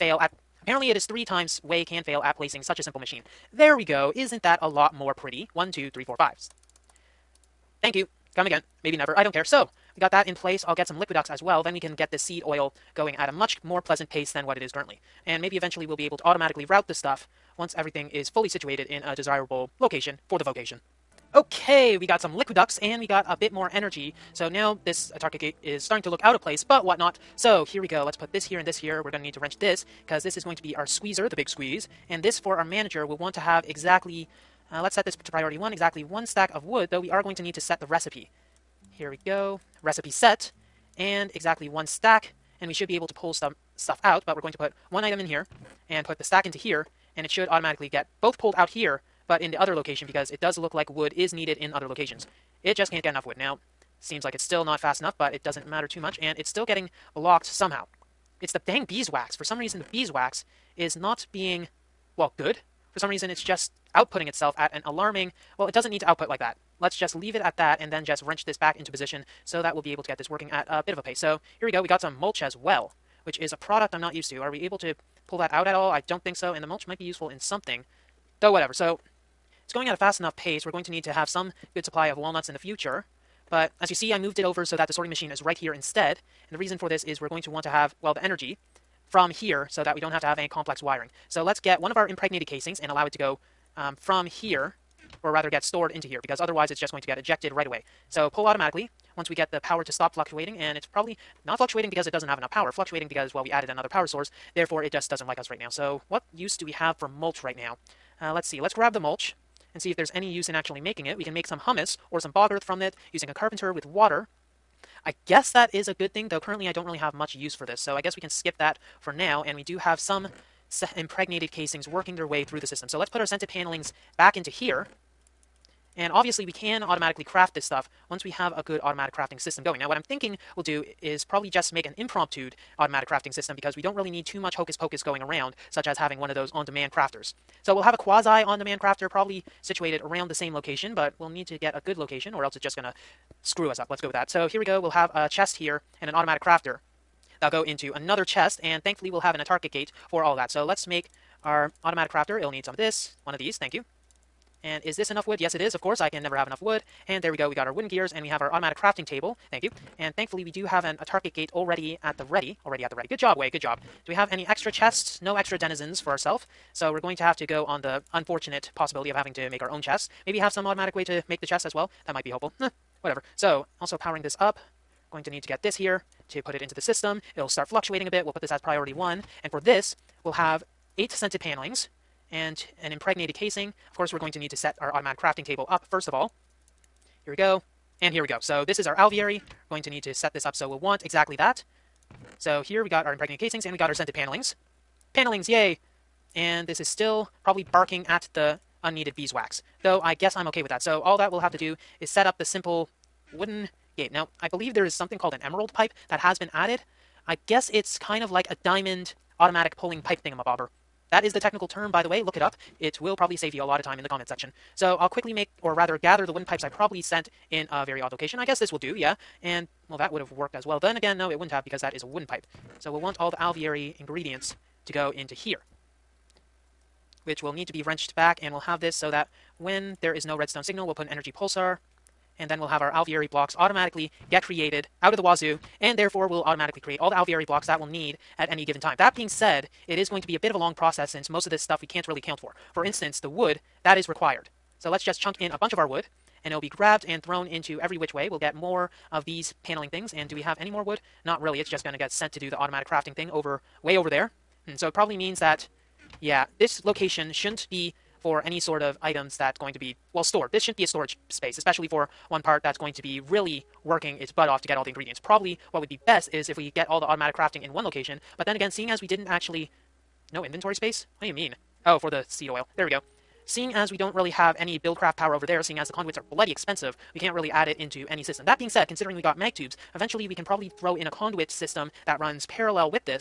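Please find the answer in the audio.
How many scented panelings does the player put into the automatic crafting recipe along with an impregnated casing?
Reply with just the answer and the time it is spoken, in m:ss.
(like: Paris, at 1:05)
8, at 3:00.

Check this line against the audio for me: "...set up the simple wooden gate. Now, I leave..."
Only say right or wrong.
wrong.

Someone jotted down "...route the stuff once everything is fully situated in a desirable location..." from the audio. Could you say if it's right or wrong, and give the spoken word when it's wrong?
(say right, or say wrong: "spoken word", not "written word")
right.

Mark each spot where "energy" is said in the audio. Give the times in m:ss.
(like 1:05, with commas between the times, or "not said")
0:23, 1:28, 3:51.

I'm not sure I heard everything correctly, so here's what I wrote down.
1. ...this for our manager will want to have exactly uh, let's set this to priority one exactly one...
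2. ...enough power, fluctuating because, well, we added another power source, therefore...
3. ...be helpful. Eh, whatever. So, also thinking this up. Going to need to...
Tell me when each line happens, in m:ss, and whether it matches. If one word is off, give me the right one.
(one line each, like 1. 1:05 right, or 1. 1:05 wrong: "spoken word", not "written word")
1. 0:32 right
2. 1:42 right
3. 2:52 wrong: "powering", not "thinking".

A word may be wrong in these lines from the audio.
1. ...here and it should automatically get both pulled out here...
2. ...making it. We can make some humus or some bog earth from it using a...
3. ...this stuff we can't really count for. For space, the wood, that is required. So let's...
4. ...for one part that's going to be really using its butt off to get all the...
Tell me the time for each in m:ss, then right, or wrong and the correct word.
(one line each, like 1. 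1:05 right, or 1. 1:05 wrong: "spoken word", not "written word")
1. 0:46 right
2. 1:50 right
3. 4:01 wrong: "instance", not "space"
4. 4:21 wrong: "working", not "using".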